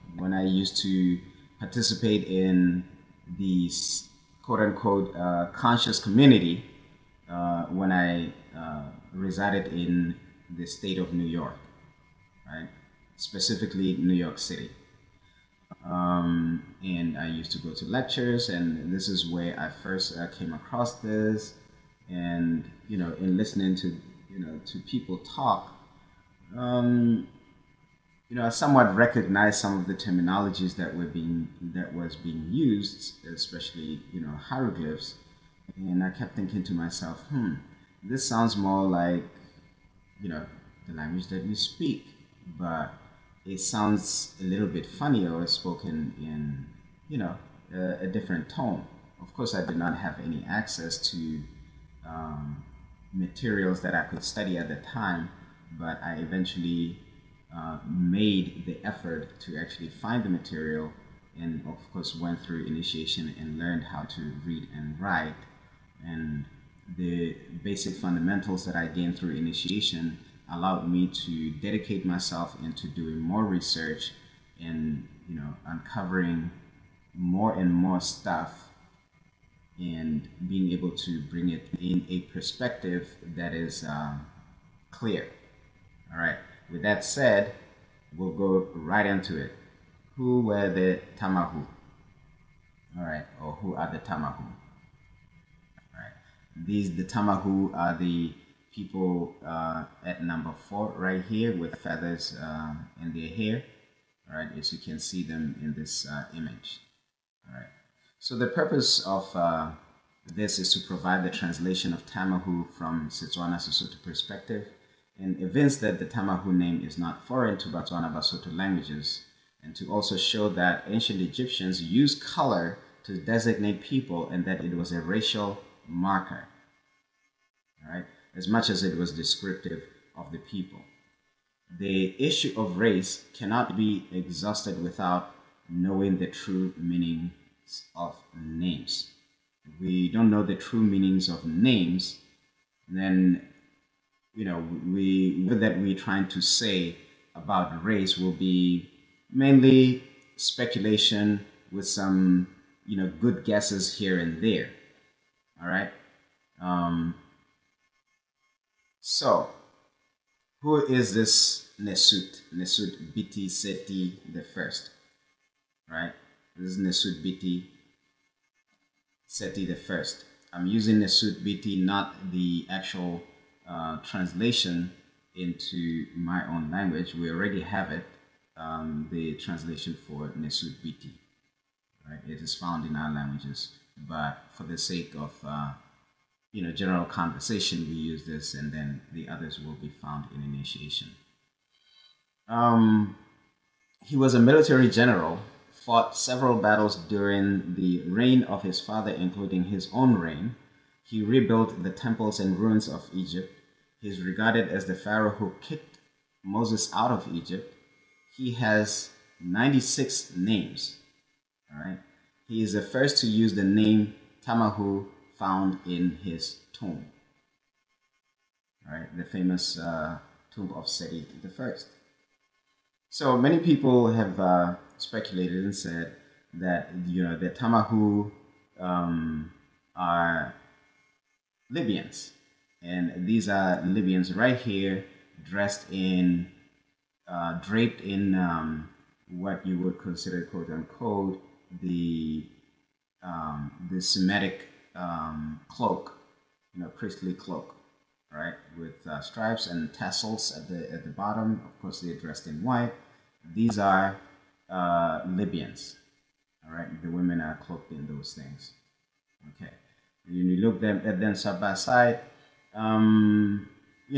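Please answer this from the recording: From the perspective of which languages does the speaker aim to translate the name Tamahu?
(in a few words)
Setswana Sesotho.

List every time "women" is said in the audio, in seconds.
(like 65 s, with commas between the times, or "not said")
257 s.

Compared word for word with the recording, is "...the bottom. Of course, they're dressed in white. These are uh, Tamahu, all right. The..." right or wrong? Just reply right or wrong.
wrong.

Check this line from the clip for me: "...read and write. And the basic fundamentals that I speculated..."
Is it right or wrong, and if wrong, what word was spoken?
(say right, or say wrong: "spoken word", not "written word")
wrong: "gained", not "speculated".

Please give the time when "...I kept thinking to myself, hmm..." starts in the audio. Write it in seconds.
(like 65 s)
36 s.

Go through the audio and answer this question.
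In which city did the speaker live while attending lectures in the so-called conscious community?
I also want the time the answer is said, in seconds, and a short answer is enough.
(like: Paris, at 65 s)
New York City, at 13 s.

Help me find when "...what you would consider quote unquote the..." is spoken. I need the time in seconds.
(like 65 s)
239 s.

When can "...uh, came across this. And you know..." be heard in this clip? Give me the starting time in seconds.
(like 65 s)
20 s.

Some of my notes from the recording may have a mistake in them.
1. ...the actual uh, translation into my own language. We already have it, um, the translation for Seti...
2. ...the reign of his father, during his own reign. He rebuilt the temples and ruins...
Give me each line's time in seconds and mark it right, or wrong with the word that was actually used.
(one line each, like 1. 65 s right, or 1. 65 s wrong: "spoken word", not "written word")
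1. 172 s wrong: "Nesut", not "Seti"
2. 197 s wrong: "including", not "during".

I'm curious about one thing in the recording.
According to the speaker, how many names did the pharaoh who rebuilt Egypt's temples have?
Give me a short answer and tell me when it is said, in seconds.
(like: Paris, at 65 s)
96, at 209 s.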